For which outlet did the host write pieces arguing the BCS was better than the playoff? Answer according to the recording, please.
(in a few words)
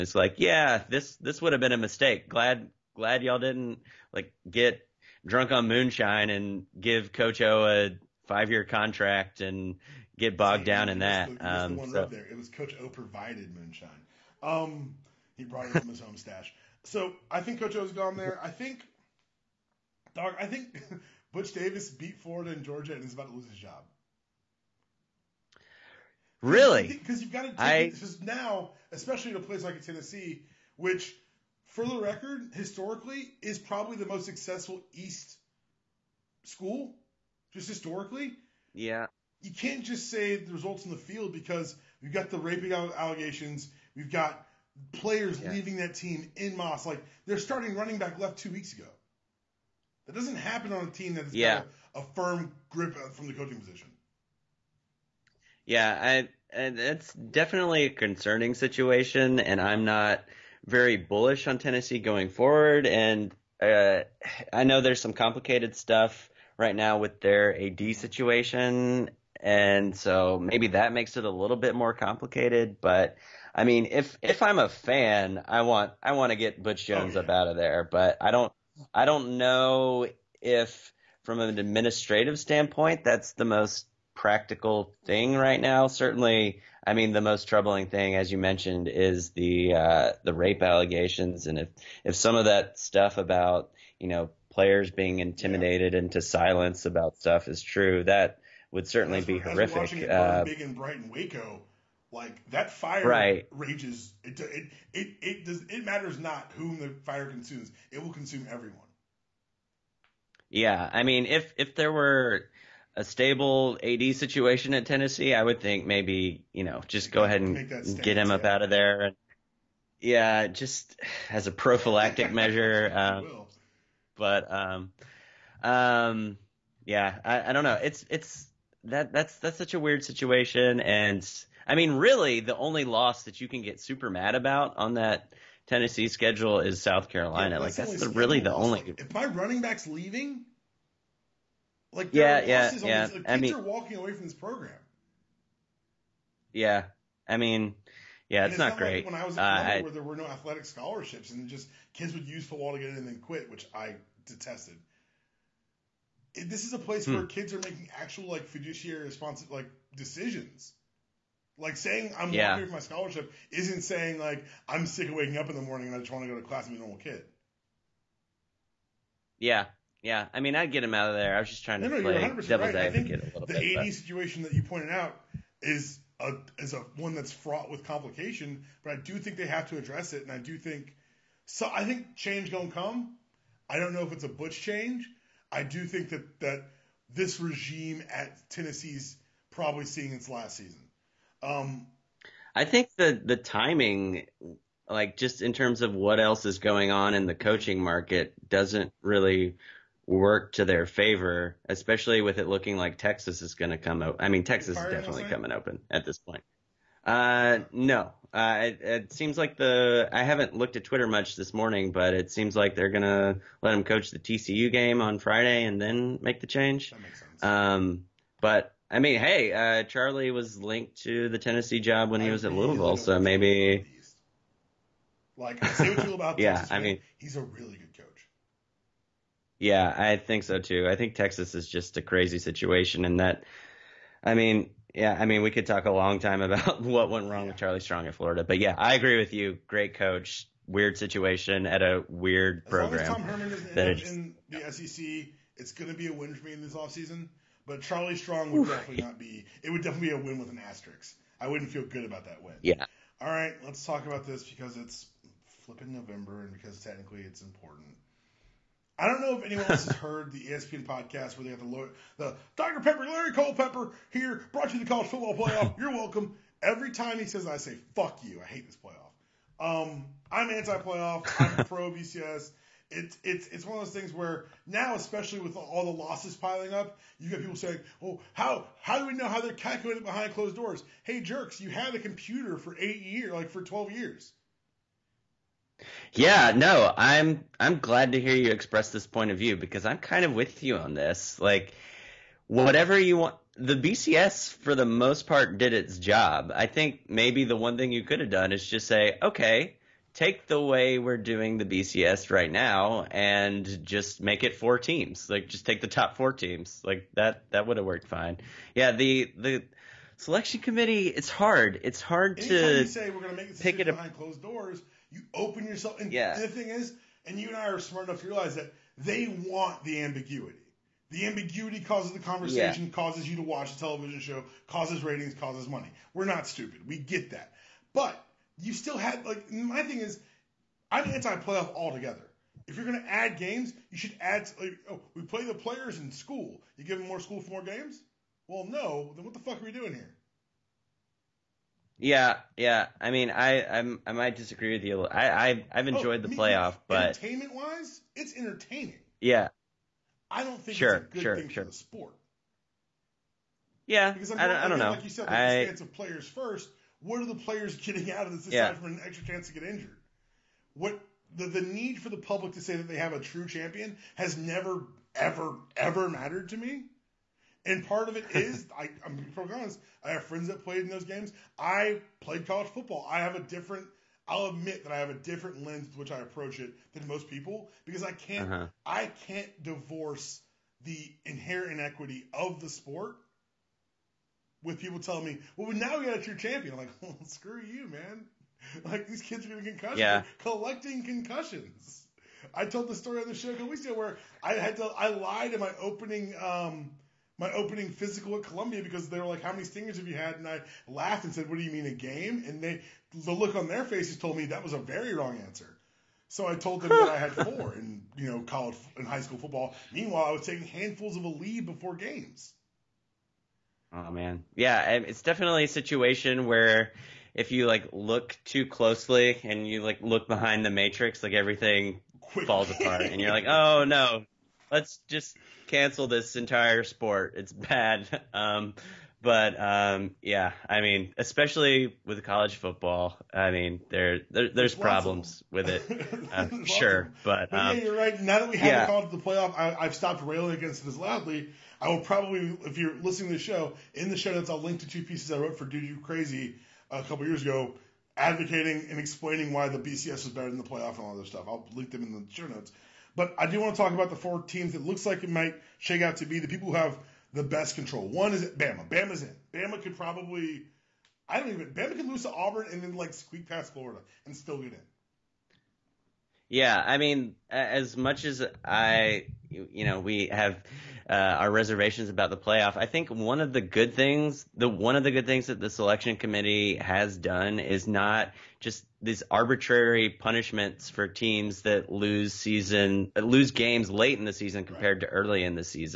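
Dude You Crazy.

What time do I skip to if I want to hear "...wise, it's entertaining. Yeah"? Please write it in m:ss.
5:47.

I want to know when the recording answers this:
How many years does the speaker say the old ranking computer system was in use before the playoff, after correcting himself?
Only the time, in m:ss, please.
4:43.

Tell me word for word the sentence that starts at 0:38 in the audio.
Yeah you can't just say the results in the field because we've got the raping allegations, we've got players yeah.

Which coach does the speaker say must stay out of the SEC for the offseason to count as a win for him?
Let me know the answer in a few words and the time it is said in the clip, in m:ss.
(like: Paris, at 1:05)
Tom Herman, at 4:03.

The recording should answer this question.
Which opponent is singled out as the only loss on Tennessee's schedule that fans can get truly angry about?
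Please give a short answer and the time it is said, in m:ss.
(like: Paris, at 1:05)
South Carolina, at 2:16.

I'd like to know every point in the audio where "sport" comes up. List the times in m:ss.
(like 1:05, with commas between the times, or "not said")
5:51, 6:22, 7:06.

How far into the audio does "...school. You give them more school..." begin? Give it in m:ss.
5:36.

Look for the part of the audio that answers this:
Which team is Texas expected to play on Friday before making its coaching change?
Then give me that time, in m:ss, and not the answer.
3:34.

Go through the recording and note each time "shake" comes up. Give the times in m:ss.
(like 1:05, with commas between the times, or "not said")
7:35.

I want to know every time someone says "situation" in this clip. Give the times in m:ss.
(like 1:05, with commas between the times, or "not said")
0:58, 1:07, 1:54, 2:10, 2:53, 3:52, 4:00, 6:55.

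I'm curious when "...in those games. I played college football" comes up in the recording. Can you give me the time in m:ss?
6:10.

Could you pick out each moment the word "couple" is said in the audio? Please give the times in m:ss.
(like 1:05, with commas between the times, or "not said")
6:33, 7:27.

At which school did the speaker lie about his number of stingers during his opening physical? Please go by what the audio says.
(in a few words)
Columbia.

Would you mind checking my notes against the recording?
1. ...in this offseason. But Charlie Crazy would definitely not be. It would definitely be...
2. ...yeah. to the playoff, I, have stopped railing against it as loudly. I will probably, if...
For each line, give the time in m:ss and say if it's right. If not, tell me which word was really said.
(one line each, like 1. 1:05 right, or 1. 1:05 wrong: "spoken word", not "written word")
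1. 4:06 wrong: "Strong", not "Crazy"
2. 7:18 right.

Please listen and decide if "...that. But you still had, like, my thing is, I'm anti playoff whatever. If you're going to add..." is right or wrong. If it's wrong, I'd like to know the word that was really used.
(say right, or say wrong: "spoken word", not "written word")
wrong: "altogether", not "whatever".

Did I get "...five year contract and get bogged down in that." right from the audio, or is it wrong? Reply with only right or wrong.
right.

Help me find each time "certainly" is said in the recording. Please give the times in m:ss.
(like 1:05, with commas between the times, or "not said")
1:25, 1:38.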